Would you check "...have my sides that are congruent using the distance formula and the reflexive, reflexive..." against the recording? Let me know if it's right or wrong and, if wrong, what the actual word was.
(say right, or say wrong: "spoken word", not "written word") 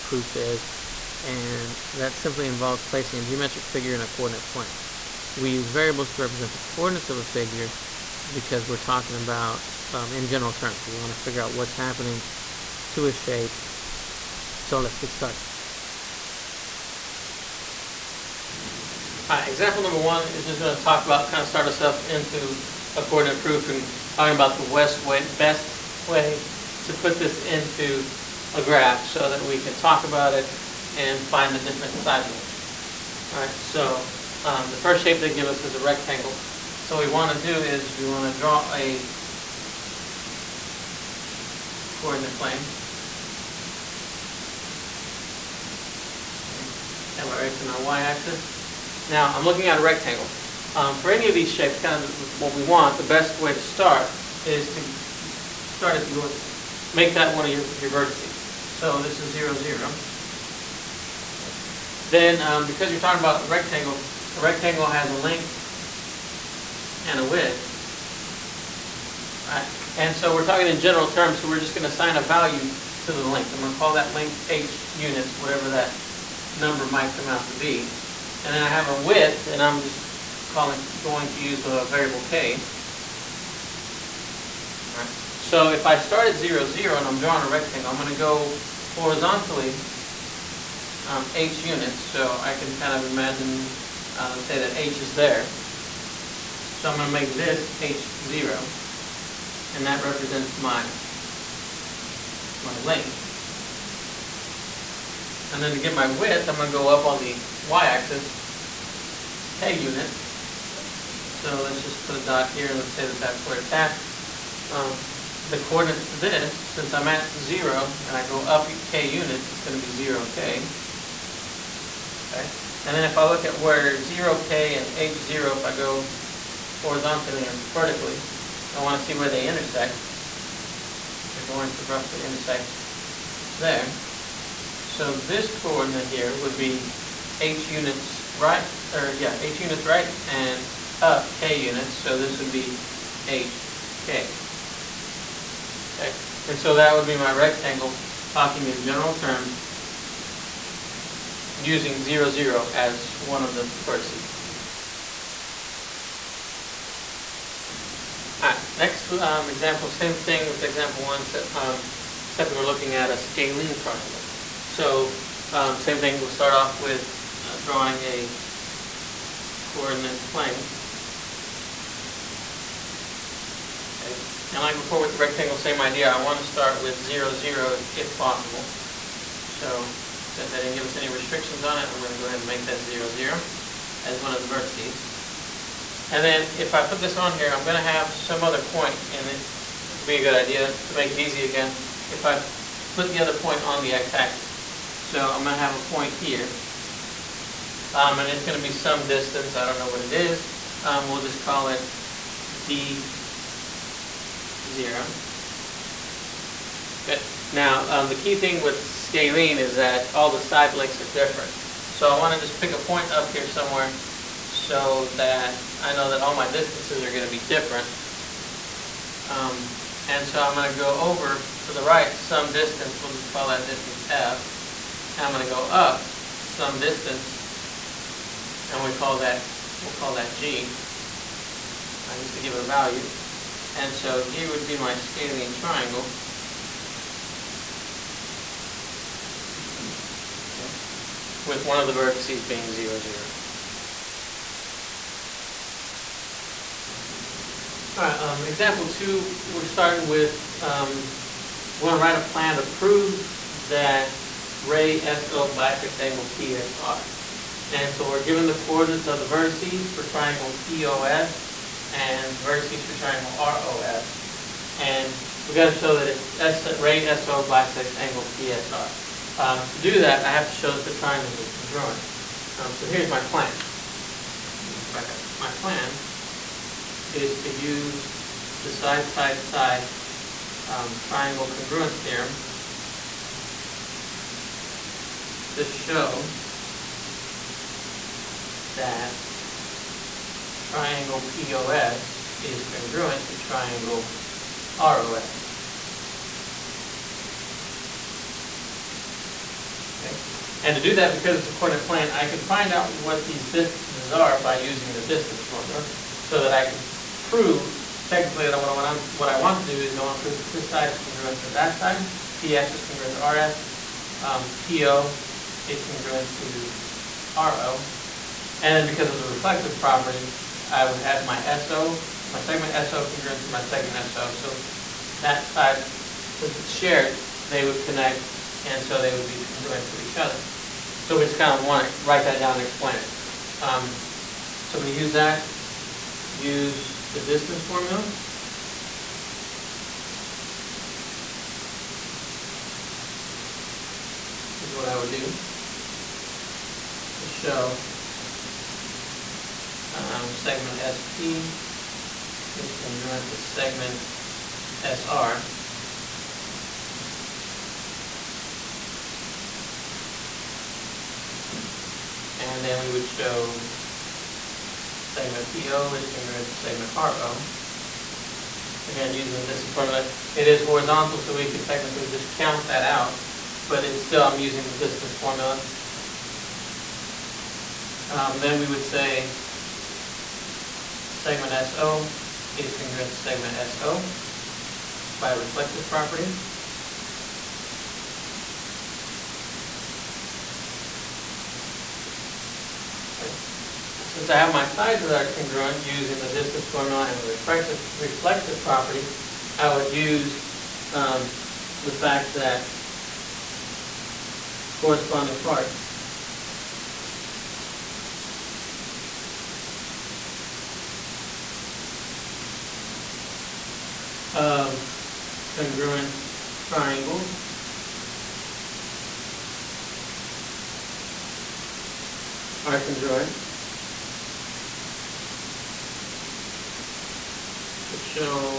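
right.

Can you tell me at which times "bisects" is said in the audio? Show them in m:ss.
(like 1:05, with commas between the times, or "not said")
4:15, 4:27.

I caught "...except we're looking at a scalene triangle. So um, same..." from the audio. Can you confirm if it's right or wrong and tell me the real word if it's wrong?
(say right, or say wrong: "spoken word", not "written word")
right.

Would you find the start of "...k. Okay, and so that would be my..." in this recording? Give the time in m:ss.
2:23.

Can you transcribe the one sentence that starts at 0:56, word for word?
Make that one of your, your vertices.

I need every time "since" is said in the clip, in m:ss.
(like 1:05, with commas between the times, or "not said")
1:56, 3:00, 5:26, 6:34.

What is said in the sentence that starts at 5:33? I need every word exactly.
Um, so I'm going to use that, use the distance formula.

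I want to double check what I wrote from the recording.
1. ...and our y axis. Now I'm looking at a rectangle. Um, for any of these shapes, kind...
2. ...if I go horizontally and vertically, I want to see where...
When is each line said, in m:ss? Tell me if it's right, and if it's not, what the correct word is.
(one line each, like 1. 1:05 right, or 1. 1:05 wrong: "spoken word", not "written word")
1. 0:47 right
2. 2:05 right.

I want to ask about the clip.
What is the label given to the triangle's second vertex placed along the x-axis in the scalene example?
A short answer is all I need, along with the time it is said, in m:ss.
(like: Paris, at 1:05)
D0, at 3:21.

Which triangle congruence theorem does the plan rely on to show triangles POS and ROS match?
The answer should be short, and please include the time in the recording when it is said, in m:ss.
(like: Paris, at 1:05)
side-side-side, at 4:38.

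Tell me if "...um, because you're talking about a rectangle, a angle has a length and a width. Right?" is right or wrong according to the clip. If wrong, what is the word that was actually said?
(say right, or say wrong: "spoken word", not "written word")
wrong: "rectangle", not "angle".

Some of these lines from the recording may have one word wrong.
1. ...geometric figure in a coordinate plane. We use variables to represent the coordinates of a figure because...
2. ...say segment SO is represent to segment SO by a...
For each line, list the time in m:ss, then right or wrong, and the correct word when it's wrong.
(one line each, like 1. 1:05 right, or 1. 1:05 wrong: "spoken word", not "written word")
1. 0:03 right
2. 6:18 wrong: "congruent", not "represent".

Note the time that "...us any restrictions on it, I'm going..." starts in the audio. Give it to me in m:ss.
3:00.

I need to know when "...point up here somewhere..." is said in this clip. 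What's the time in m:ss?
3:32.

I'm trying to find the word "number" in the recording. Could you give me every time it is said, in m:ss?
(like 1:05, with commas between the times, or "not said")
0:19, 1:16.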